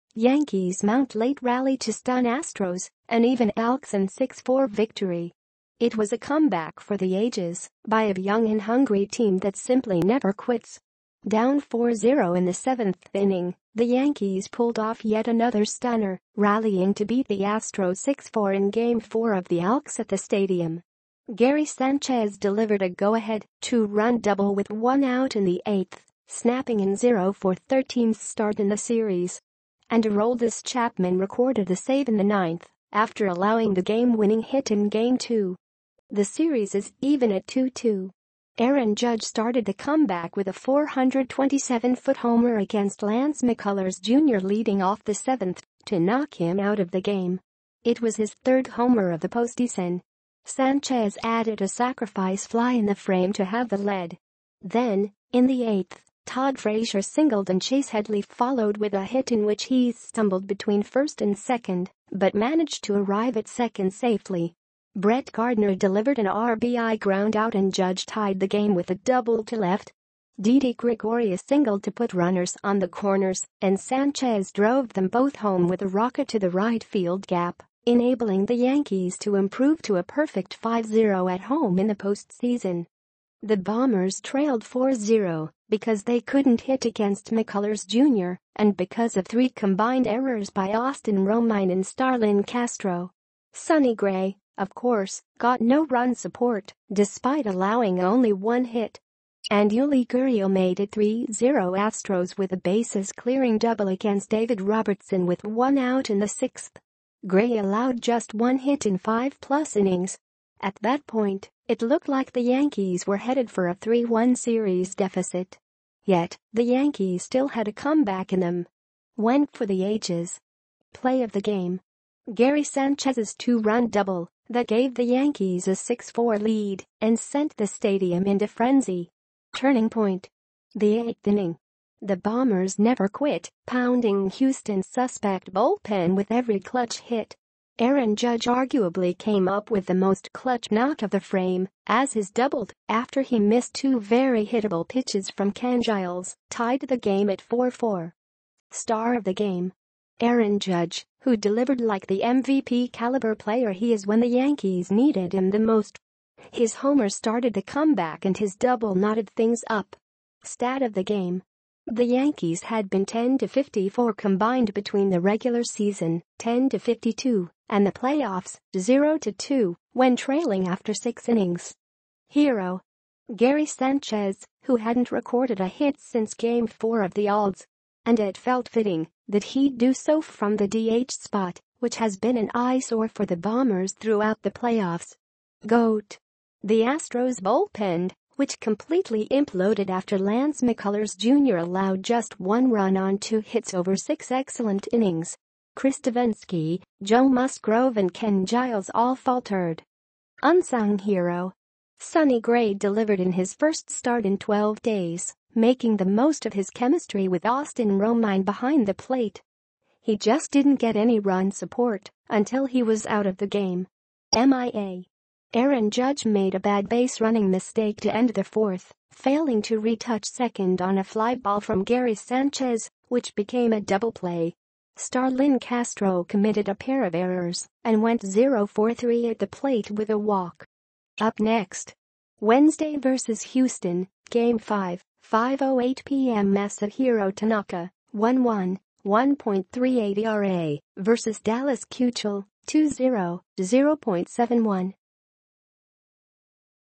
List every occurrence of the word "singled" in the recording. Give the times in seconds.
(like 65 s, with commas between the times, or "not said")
57 s, 71 s.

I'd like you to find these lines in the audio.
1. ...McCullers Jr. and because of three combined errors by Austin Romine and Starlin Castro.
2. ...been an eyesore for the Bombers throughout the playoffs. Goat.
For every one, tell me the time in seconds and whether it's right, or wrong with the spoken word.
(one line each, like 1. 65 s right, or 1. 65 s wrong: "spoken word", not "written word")
1. 87 s right
2. 182 s right.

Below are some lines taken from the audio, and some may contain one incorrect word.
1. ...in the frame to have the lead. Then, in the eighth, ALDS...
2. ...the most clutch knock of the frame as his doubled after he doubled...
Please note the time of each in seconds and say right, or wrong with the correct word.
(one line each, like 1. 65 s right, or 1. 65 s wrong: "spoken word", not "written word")
1. 52 s wrong: "Todd", not "ALDS"
2. 139 s wrong: "missed", not "doubled".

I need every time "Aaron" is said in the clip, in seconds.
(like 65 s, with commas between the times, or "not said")
38 s, 137 s, 150 s, 215 s.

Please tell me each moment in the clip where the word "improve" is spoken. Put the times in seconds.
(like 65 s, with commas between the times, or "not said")
79 s.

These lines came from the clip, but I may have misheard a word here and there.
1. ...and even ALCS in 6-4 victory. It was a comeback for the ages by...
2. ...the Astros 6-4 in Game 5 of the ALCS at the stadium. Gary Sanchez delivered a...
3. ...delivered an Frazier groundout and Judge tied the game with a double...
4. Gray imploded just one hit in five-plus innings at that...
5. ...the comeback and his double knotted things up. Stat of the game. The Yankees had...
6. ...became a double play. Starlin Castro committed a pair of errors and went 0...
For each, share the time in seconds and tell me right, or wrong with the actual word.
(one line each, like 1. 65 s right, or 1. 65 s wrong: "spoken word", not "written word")
1. 3 s right
2. 17 s wrong: "4", not "5"
3. 65 s wrong: "RBI", not "Frazier"
4. 107 s wrong: "allowed", not "imploded"
5. 157 s right
6. 223 s right.